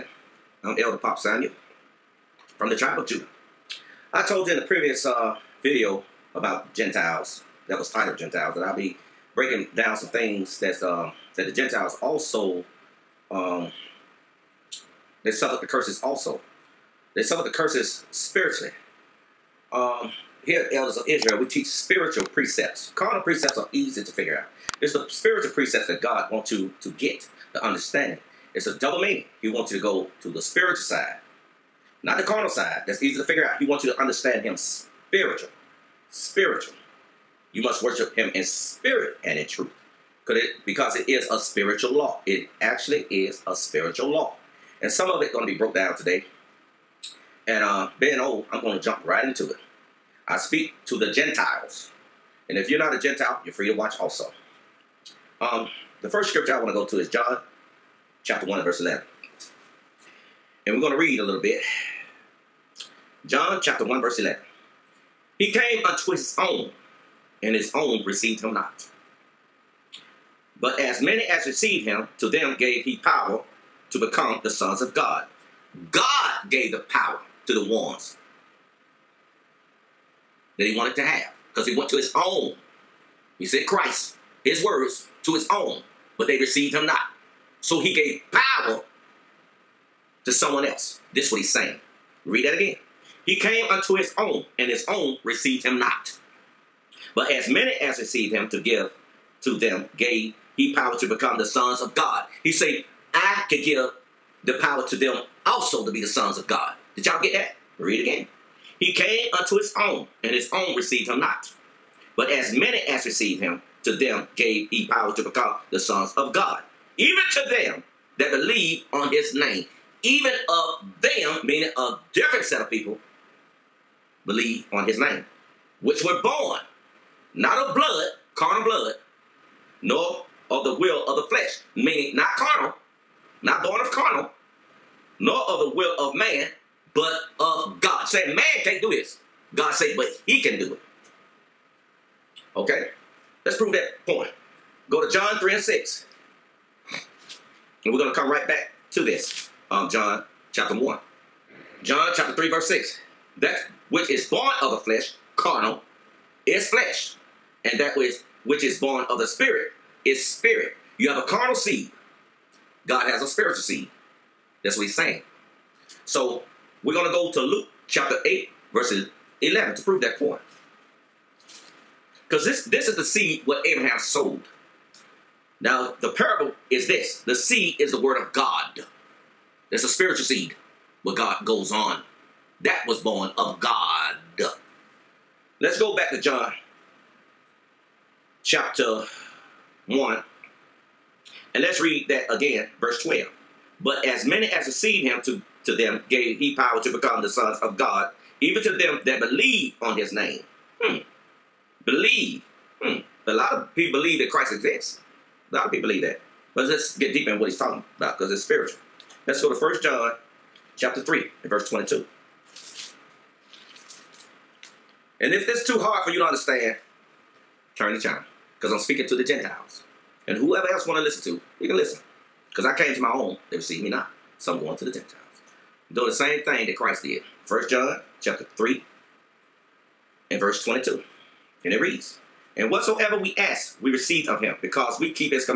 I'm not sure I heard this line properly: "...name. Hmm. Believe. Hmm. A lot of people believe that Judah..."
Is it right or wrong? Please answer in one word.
wrong.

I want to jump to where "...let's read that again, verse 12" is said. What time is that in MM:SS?
03:11.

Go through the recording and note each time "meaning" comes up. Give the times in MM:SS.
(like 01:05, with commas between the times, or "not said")
00:29, 02:01, 02:11.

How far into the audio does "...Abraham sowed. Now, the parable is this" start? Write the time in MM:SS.
02:53.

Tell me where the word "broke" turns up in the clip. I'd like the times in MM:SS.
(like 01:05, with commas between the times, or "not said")
00:45.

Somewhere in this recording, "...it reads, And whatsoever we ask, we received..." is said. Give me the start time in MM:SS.
03:51.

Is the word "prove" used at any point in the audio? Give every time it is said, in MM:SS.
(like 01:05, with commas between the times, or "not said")
02:23, 02:49.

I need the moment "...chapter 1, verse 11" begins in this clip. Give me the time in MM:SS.
01:03.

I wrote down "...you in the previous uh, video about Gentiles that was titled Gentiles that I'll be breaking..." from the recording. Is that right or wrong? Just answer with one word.
right.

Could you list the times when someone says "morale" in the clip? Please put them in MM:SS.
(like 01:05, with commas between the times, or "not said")
not said.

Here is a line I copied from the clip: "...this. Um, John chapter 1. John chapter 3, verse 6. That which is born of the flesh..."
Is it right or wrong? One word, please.
right.